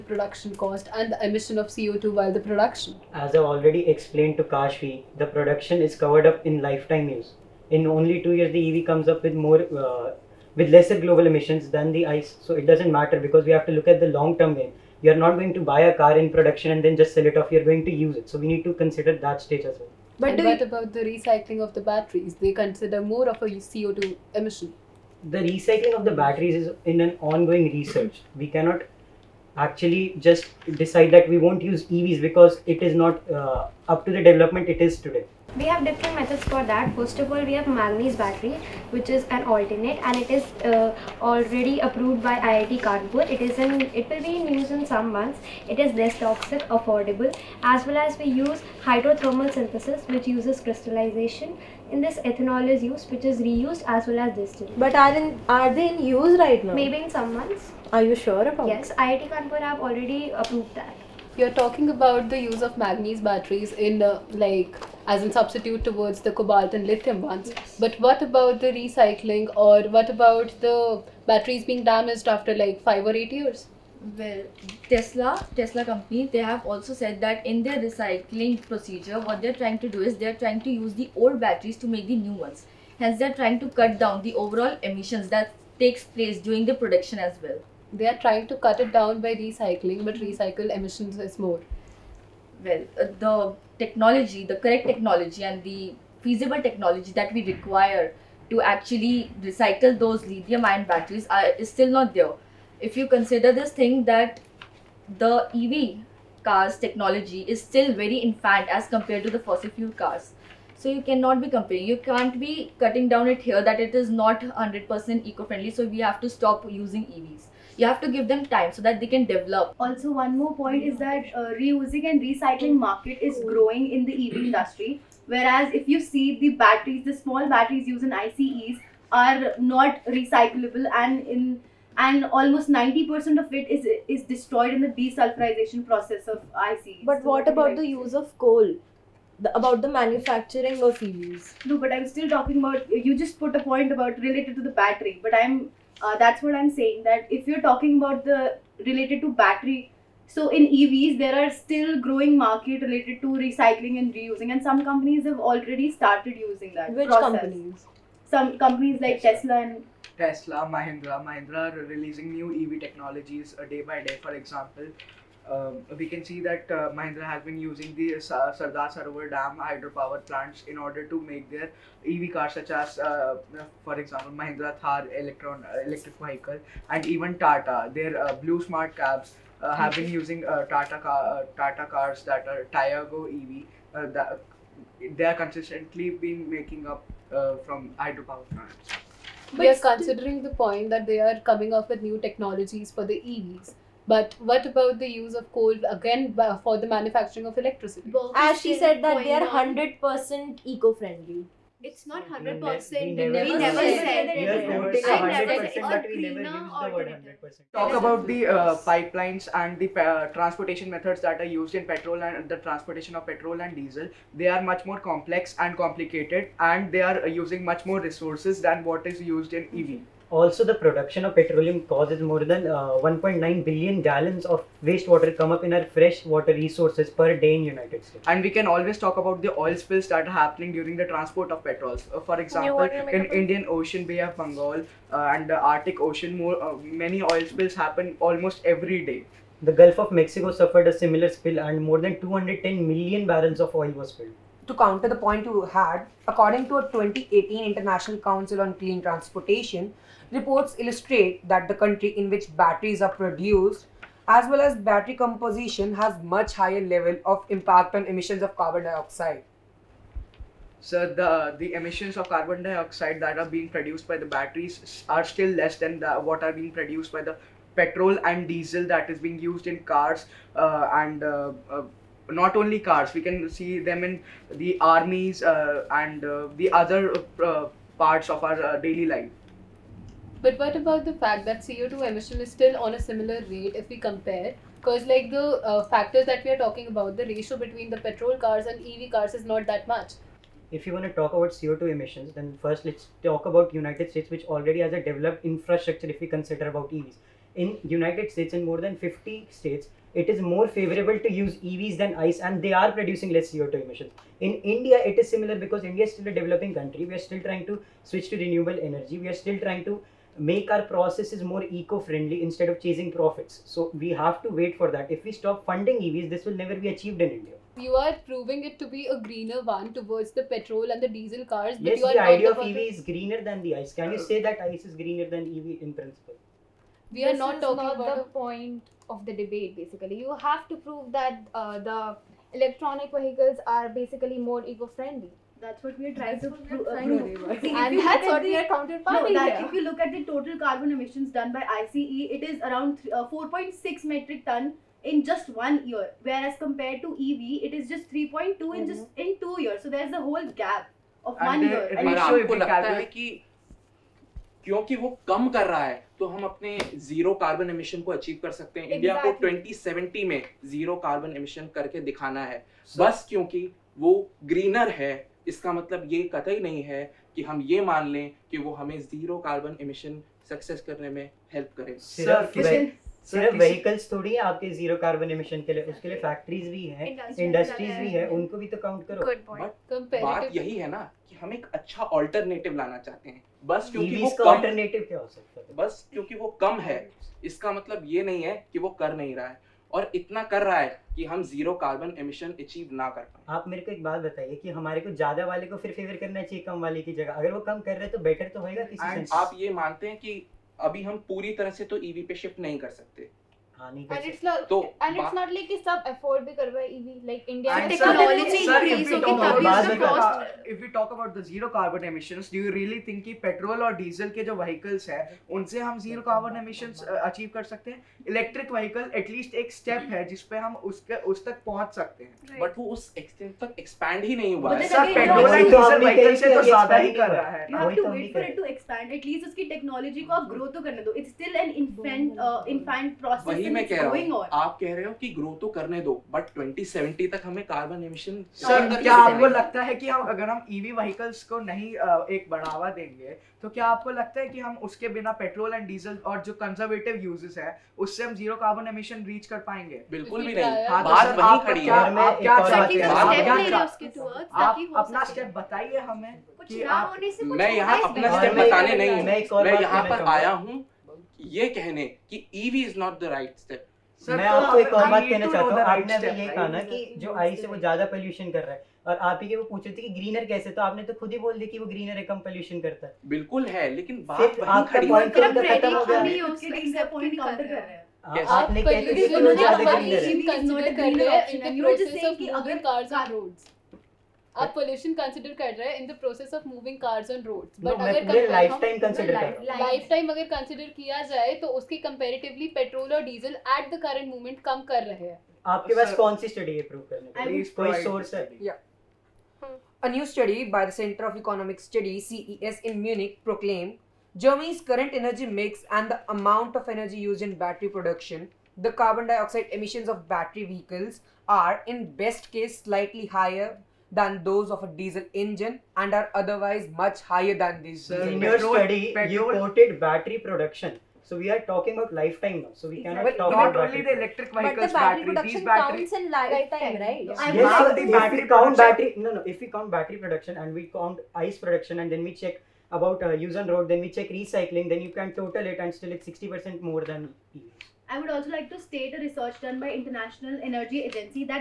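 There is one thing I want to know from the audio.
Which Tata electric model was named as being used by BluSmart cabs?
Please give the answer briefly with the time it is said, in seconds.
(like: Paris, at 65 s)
Tiago EV, at 182 s.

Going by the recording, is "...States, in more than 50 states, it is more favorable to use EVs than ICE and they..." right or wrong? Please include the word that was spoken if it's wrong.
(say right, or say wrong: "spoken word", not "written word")
right.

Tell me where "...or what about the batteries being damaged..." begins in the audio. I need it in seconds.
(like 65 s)
69 s.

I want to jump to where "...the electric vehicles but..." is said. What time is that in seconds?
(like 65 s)
524 s.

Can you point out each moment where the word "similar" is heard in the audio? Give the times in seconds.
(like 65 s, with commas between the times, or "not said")
240 s, 282 s, 305 s.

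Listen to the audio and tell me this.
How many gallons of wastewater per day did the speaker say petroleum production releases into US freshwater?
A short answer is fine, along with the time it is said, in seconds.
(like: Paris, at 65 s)
1.9 billion gallons, at 223 s.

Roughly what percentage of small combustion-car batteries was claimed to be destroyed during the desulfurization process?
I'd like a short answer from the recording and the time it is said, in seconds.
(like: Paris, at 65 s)
90%, at 132 s.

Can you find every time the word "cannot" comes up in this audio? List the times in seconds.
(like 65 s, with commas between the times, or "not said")
28 s, 111 s, 523 s.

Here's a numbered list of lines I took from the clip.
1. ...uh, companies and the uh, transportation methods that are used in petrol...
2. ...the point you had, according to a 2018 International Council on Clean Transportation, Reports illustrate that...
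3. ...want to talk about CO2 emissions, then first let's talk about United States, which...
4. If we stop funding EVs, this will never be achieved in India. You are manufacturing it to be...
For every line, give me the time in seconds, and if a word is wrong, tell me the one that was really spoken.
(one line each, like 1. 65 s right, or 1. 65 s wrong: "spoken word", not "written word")
1. 208 s wrong: "pipelines", not "companies"
2. 245 s right
3. 290 s right
4. 315 s wrong: "proving", not "manufacturing".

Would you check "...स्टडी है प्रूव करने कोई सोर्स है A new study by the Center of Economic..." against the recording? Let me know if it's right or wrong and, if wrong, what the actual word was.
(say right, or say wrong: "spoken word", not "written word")
right.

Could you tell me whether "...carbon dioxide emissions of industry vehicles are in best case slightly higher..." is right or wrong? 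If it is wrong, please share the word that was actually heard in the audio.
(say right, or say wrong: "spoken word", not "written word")
wrong: "battery", not "industry".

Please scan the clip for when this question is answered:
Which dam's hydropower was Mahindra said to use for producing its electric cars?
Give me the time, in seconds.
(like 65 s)
168 s.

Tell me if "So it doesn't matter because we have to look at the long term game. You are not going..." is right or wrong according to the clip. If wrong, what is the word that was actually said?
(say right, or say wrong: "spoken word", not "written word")
right.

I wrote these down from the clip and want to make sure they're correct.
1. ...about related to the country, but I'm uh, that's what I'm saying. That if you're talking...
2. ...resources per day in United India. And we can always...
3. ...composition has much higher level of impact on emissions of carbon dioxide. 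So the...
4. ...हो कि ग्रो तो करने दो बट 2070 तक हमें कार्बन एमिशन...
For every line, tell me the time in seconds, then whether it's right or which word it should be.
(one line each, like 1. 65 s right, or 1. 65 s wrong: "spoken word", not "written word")
1. 143 s wrong: "battery", not "country"
2. 226 s wrong: "States", not "India"
3. 255 s right
4. 435 s right.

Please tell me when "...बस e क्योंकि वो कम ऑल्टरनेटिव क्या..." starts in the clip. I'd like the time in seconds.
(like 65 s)
383 s.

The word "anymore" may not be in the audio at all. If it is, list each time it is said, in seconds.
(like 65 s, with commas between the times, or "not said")
not said.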